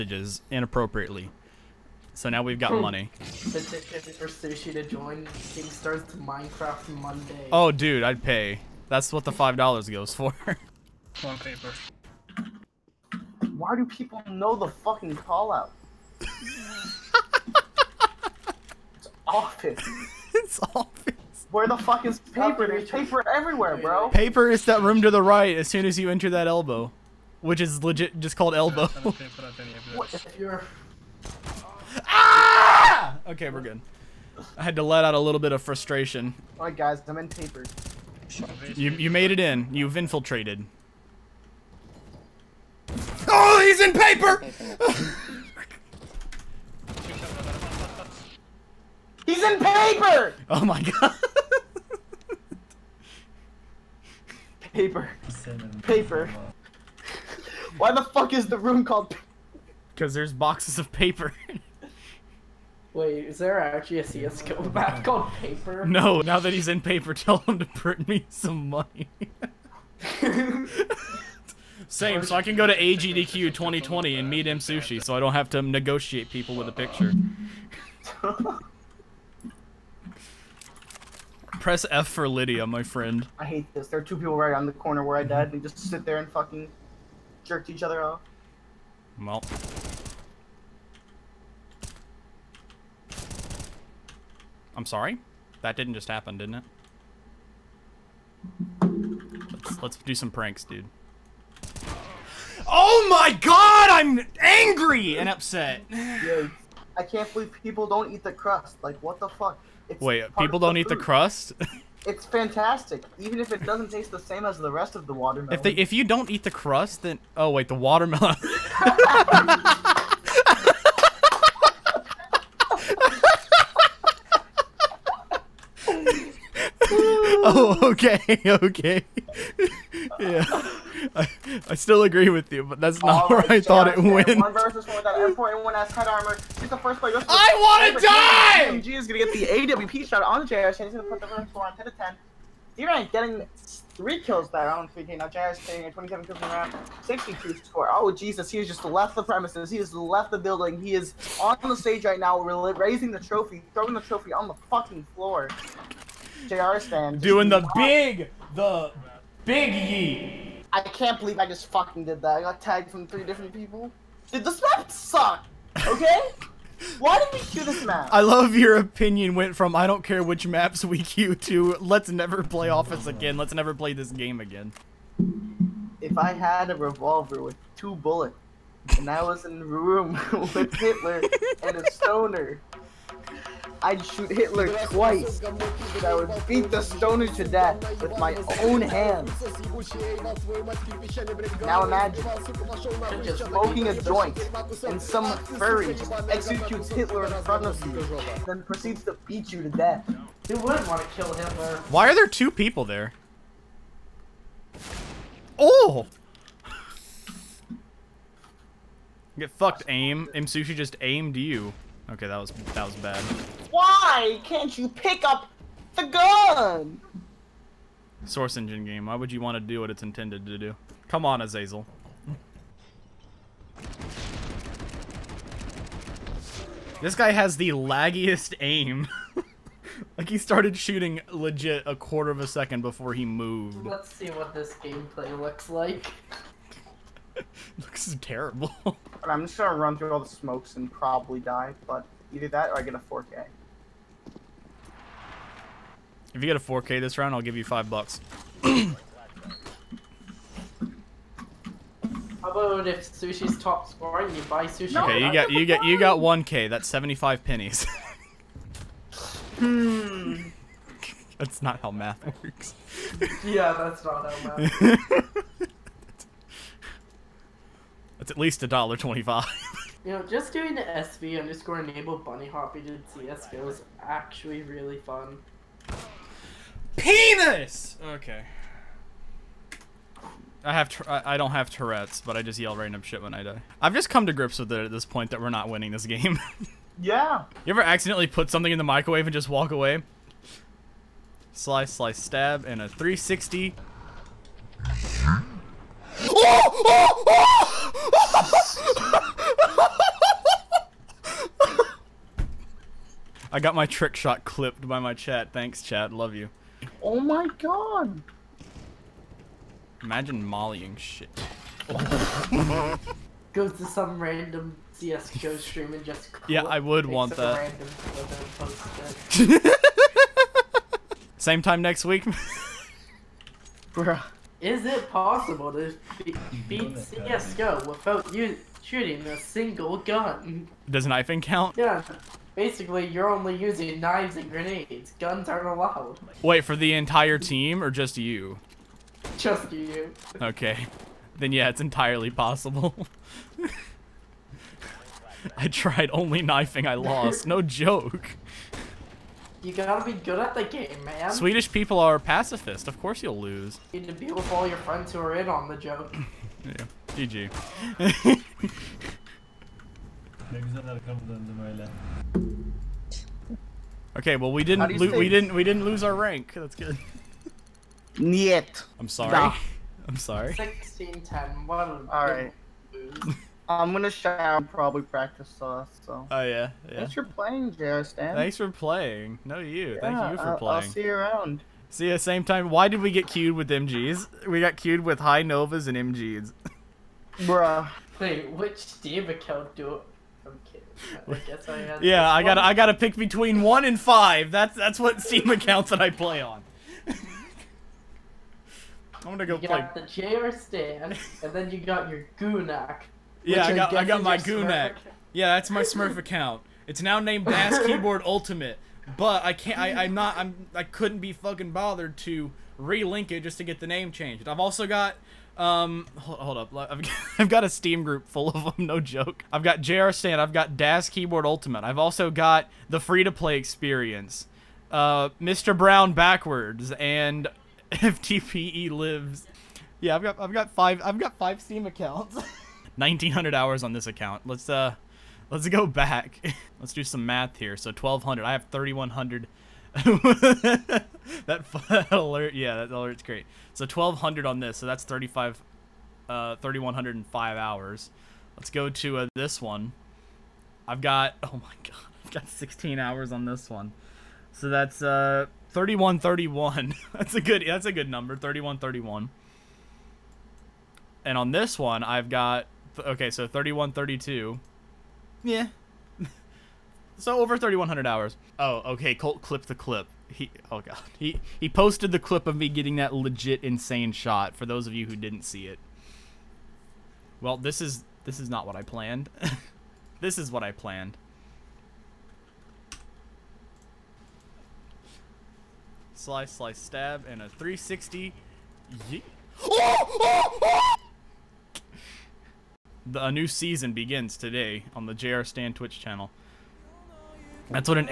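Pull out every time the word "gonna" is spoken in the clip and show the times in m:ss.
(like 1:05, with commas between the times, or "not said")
3:59, 6:13, 6:39.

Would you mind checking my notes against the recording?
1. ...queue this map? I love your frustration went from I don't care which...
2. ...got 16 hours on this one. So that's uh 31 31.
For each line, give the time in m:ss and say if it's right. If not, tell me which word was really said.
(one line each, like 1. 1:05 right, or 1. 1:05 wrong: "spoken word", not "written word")
1. 2:47 wrong: "opinion", not "frustration"
2. 7:32 right.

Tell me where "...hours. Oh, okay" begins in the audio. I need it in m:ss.
7:48.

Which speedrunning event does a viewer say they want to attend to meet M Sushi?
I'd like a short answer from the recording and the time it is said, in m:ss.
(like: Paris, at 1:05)
AGDQ 2020, at 1:12.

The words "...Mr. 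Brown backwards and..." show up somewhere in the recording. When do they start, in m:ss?
7:05.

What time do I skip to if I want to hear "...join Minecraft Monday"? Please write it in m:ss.
0:04.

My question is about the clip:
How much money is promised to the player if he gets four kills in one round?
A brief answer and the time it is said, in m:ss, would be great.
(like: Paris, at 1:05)
5 dollars, at 4:07.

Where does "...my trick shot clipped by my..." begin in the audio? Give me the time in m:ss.
5:03.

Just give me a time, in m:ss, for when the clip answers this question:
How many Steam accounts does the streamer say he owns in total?
7:11.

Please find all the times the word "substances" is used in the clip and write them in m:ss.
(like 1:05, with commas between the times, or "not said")
not said.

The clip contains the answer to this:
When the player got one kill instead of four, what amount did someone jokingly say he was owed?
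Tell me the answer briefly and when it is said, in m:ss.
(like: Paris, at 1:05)
75 pennies, at 4:16.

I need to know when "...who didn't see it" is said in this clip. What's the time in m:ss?
7:55.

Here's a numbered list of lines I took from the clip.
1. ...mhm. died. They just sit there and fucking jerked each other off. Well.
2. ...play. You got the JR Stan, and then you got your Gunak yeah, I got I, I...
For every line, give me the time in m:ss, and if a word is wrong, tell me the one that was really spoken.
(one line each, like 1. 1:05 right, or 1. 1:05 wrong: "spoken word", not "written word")
1. 1:25 right
2. 6:39 right.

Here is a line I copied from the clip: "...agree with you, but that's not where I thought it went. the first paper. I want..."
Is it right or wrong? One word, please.
wrong.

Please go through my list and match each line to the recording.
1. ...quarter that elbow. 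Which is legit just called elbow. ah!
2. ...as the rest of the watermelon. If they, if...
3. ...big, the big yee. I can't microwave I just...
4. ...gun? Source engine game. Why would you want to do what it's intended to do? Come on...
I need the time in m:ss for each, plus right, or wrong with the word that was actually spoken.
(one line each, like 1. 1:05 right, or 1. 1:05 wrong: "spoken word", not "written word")
1. 0:26 wrong: "enter", not "quarter"
2. 1:54 right
3. 2:37 wrong: "believe", not "microwave"
4. 3:36 right.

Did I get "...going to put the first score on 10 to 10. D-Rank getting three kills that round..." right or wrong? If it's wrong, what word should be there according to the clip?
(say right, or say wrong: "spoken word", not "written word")
right.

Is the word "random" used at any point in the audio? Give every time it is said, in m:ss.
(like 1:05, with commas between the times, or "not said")
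4:42, 5:14.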